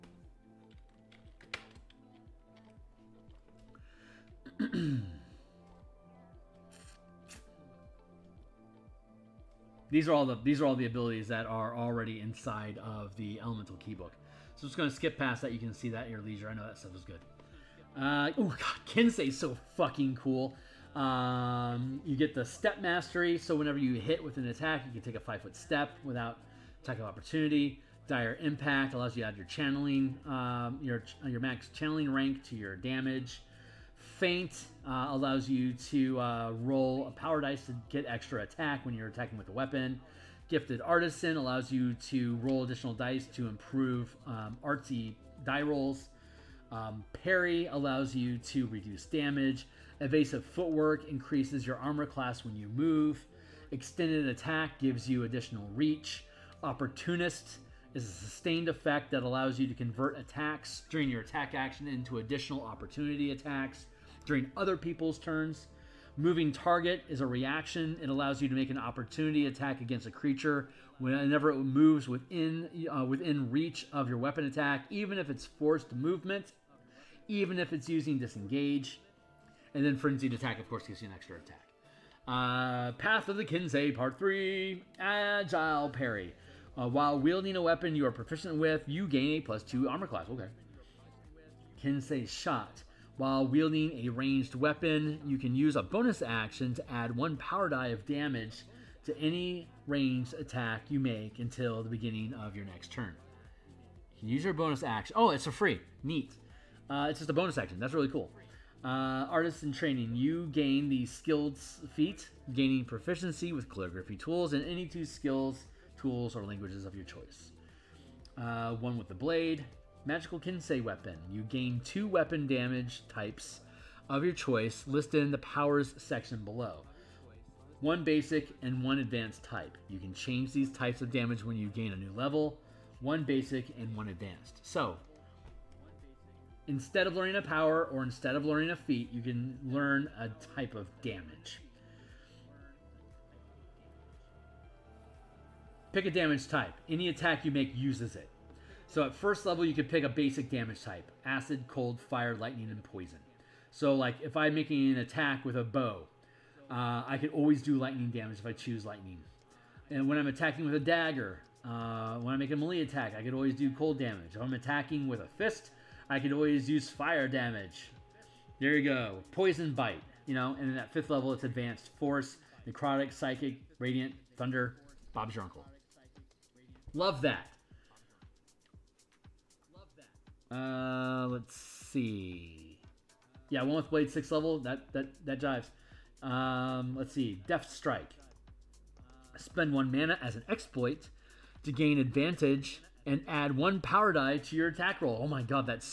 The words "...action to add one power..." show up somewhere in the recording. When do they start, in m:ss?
1:36.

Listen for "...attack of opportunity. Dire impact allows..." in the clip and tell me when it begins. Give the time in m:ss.
0:26.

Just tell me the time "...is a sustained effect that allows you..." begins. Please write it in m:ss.
0:57.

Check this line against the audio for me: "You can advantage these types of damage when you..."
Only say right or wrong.
wrong.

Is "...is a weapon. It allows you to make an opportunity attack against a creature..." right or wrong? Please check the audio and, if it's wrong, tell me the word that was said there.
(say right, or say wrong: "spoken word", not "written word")
wrong: "reaction", not "weapon".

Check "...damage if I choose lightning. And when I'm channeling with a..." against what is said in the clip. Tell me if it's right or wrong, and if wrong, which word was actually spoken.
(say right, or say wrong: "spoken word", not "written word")
wrong: "attacking", not "channeling".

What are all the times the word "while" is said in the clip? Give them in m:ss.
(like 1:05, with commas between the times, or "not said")
1:26, 1:33.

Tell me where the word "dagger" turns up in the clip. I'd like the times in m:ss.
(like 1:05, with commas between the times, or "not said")
2:40.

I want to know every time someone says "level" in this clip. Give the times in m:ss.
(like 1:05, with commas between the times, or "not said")
2:12, 2:29, 2:51, 3:04.